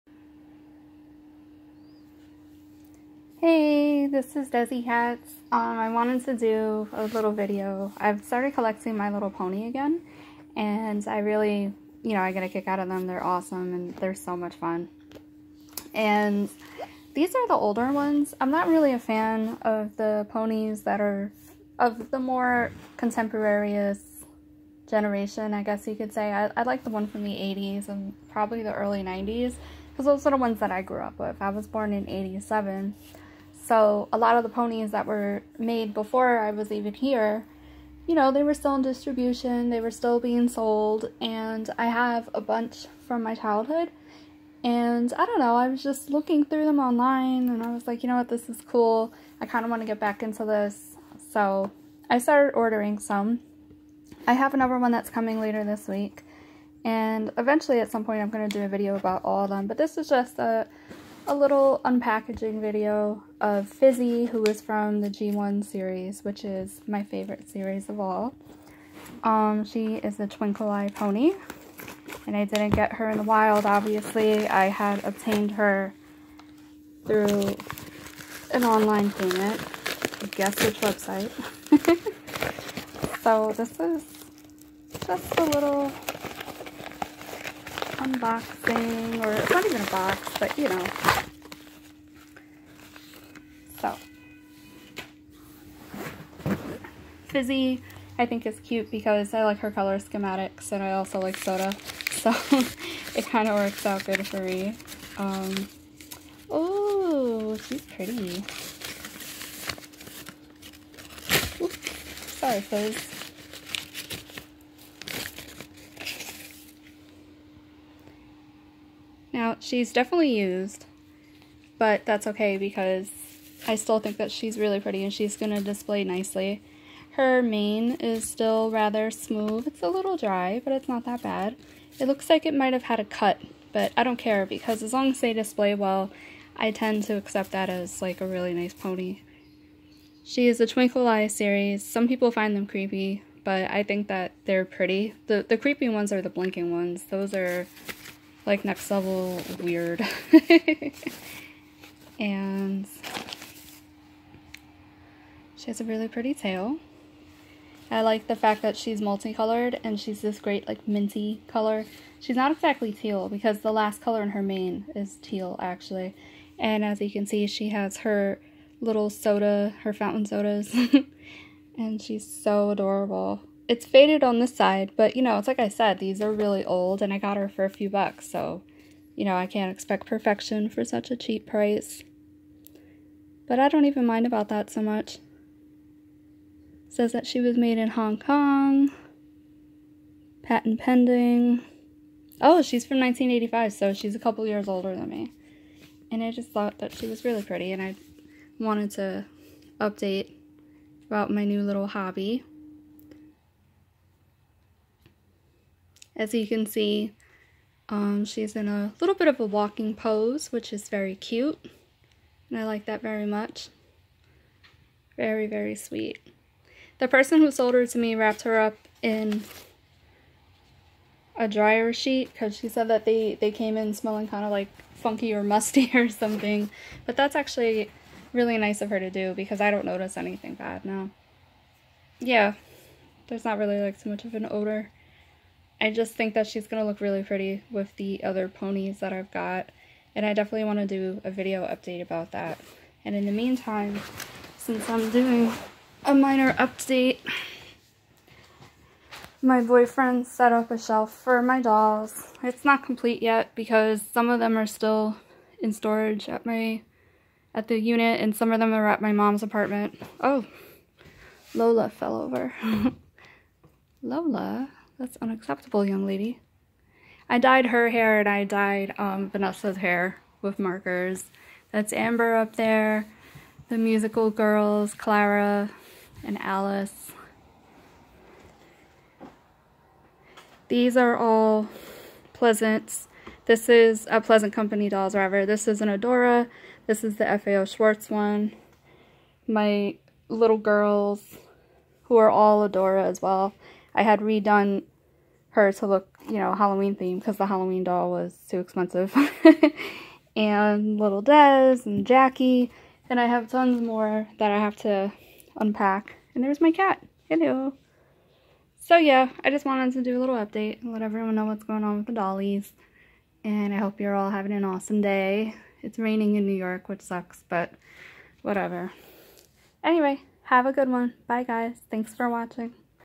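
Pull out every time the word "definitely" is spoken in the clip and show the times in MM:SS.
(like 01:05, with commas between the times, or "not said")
01:59, 04:00.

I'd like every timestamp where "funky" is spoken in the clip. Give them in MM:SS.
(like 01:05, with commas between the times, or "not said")
03:44.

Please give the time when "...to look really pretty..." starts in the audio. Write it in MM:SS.
03:56.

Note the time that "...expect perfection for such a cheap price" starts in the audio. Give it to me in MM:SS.
02:59.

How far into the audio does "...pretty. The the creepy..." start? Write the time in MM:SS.
02:24.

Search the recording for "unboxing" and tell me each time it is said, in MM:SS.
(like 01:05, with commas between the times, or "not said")
01:28.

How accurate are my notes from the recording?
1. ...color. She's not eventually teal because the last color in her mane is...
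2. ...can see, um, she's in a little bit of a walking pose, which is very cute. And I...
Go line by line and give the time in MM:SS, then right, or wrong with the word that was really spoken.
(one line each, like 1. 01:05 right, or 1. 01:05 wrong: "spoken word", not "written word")
1. 02:41 wrong: "exactly", not "eventually"
2. 03:26 right.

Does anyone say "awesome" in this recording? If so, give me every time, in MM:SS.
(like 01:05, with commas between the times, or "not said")
00:13, 05:14.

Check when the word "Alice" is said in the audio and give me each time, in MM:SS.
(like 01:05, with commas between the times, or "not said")
04:36.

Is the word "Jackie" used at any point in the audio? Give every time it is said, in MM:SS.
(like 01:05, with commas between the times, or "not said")
05:02.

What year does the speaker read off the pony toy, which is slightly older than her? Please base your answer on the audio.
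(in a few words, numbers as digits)
1985.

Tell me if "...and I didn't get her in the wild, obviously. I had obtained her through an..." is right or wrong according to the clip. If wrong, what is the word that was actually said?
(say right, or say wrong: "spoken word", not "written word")
right.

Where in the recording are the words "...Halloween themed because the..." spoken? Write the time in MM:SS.
04:56.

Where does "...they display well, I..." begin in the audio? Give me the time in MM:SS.
02:15.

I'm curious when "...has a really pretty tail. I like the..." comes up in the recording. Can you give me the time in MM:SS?
02:35.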